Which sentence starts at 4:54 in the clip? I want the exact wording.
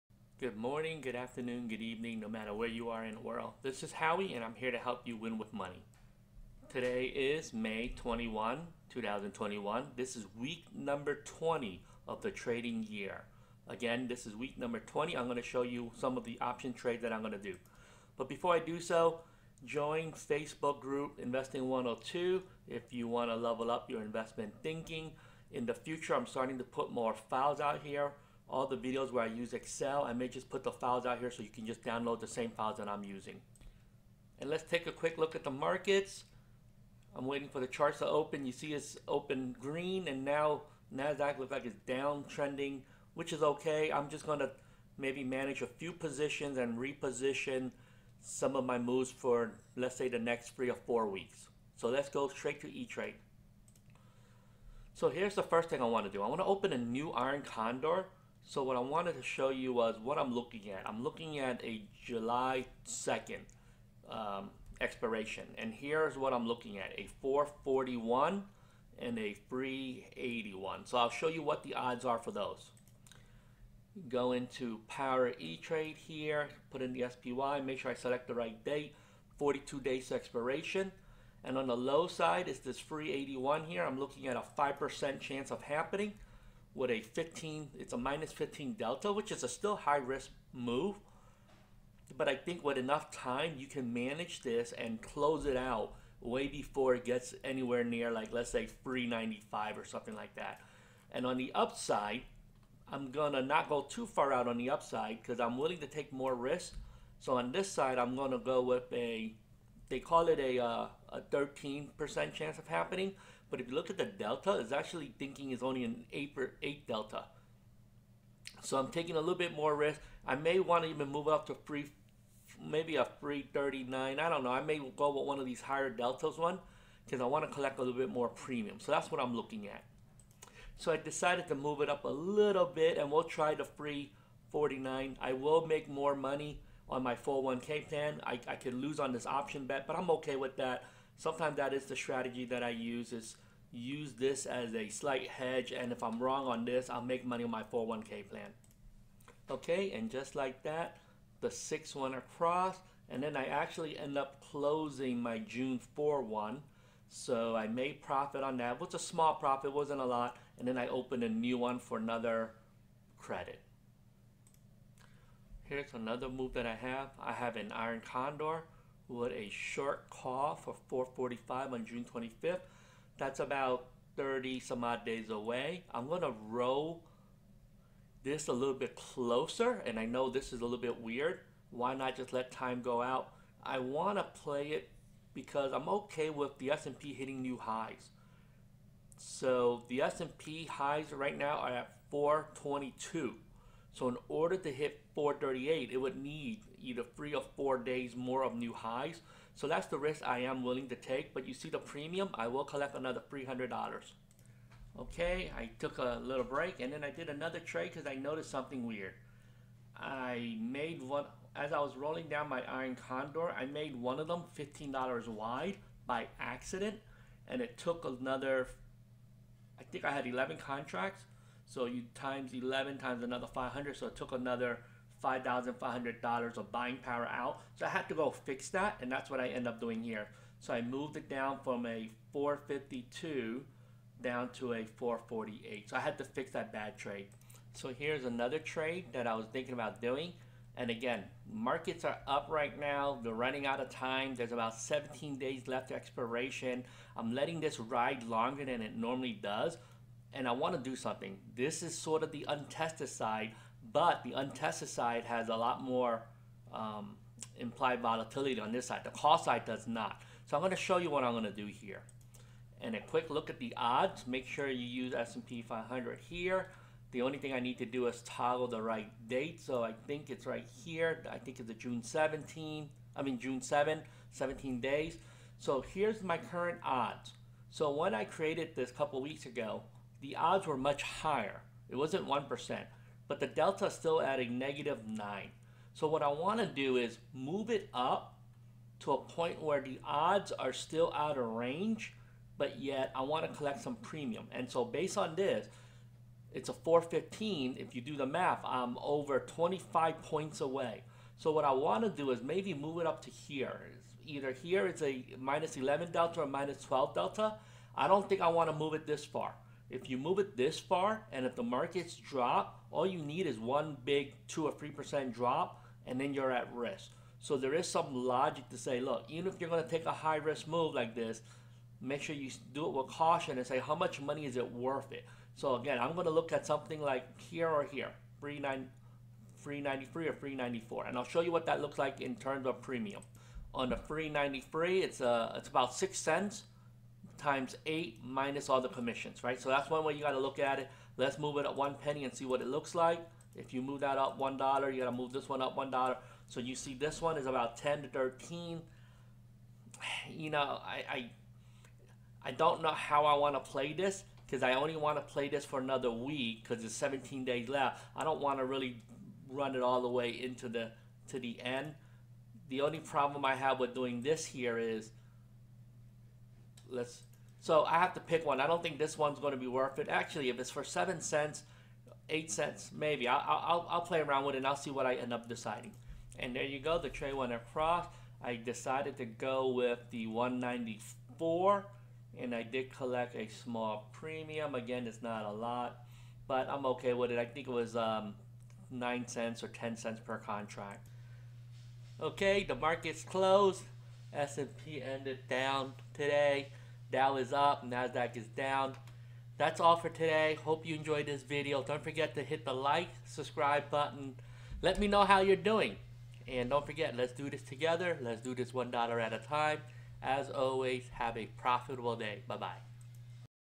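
And so based on this, it's a 415.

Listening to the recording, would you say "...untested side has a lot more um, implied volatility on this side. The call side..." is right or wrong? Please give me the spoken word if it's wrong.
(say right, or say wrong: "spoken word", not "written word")
right.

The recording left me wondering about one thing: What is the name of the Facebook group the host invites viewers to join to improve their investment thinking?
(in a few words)
Investing 102.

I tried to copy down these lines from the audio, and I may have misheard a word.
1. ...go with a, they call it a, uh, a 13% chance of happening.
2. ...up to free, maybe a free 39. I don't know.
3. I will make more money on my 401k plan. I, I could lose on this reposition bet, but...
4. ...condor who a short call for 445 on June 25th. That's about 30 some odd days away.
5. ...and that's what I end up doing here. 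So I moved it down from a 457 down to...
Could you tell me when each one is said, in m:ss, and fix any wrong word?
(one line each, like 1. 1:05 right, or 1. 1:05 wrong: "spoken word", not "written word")
1. 1:48 right
2. 2:01 right
3. 2:15 wrong: "option", not "reposition"
4. 2:48 right
5. 3:49 wrong: "452", not "457".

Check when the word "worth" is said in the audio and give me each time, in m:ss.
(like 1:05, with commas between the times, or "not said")
5:24, 6:09.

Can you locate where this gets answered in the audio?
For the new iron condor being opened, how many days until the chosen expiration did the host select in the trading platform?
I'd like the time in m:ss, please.
1:19.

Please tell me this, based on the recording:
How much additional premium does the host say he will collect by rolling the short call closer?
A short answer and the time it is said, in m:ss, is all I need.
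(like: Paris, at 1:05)
$300, at 3:23.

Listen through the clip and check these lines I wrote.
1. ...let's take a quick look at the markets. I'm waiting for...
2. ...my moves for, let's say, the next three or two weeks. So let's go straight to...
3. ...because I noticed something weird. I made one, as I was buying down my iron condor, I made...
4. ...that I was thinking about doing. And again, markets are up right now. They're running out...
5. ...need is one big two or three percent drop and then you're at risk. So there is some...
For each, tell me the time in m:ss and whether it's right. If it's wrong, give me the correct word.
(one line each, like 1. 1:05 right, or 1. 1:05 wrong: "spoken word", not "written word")
1. 0:34 right
2. 0:48 wrong: "four", not "two"
3. 3:27 wrong: "rolling", not "buying"
4. 3:59 right
5. 5:13 right.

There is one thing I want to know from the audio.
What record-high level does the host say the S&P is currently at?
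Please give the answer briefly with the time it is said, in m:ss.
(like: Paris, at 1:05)
422, at 3:12.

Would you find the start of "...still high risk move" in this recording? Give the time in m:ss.
1:29.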